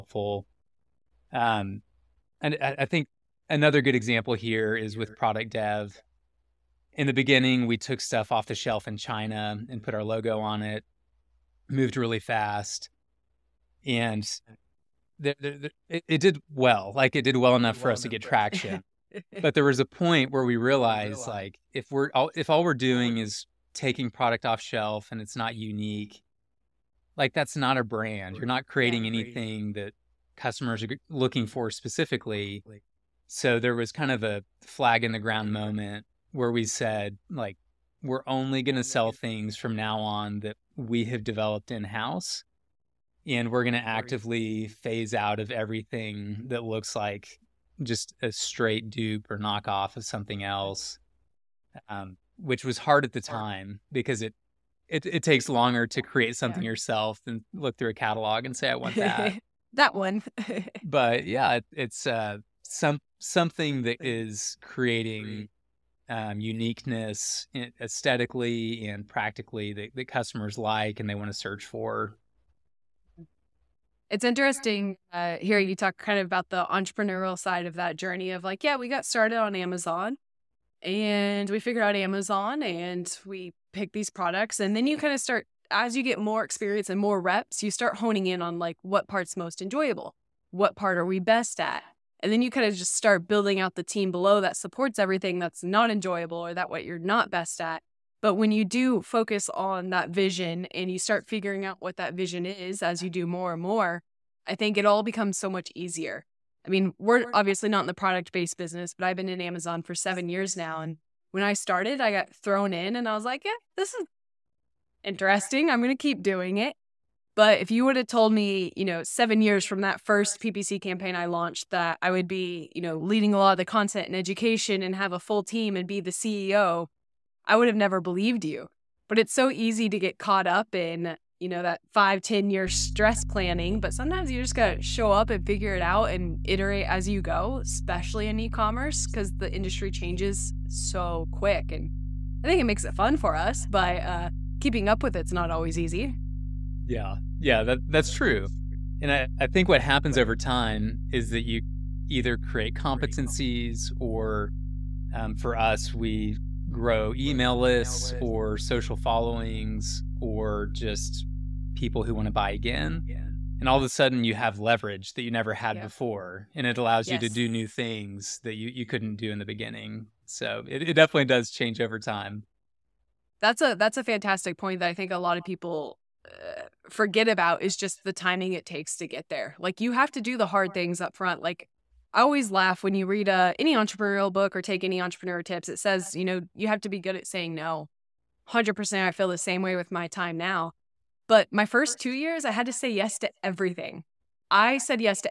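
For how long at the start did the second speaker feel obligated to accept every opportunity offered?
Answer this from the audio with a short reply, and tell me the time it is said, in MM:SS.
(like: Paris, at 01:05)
2 years, at 03:11.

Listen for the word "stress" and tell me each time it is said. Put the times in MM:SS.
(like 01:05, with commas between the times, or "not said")
02:12.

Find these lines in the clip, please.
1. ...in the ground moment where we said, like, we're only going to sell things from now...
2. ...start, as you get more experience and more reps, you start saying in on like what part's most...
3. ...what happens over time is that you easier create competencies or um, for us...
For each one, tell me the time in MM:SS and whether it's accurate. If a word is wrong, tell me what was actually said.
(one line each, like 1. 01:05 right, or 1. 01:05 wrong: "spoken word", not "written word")
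1. 00:35 right
2. 01:25 wrong: "honing", not "saying"
3. 02:29 wrong: "either", not "easier".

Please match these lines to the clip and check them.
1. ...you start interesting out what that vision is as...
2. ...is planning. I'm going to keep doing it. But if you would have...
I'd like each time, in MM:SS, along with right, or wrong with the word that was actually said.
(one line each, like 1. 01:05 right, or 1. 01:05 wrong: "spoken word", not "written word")
1. 01:40 wrong: "figuring", not "interesting"
2. 01:53 wrong: "interesting", not "planning".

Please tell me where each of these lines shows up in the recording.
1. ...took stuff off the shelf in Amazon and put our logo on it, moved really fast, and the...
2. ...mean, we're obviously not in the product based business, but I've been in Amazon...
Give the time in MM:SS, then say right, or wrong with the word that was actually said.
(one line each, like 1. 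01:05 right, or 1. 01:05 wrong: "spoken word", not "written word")
1. 00:07 wrong: "China", not "Amazon"
2. 01:46 right.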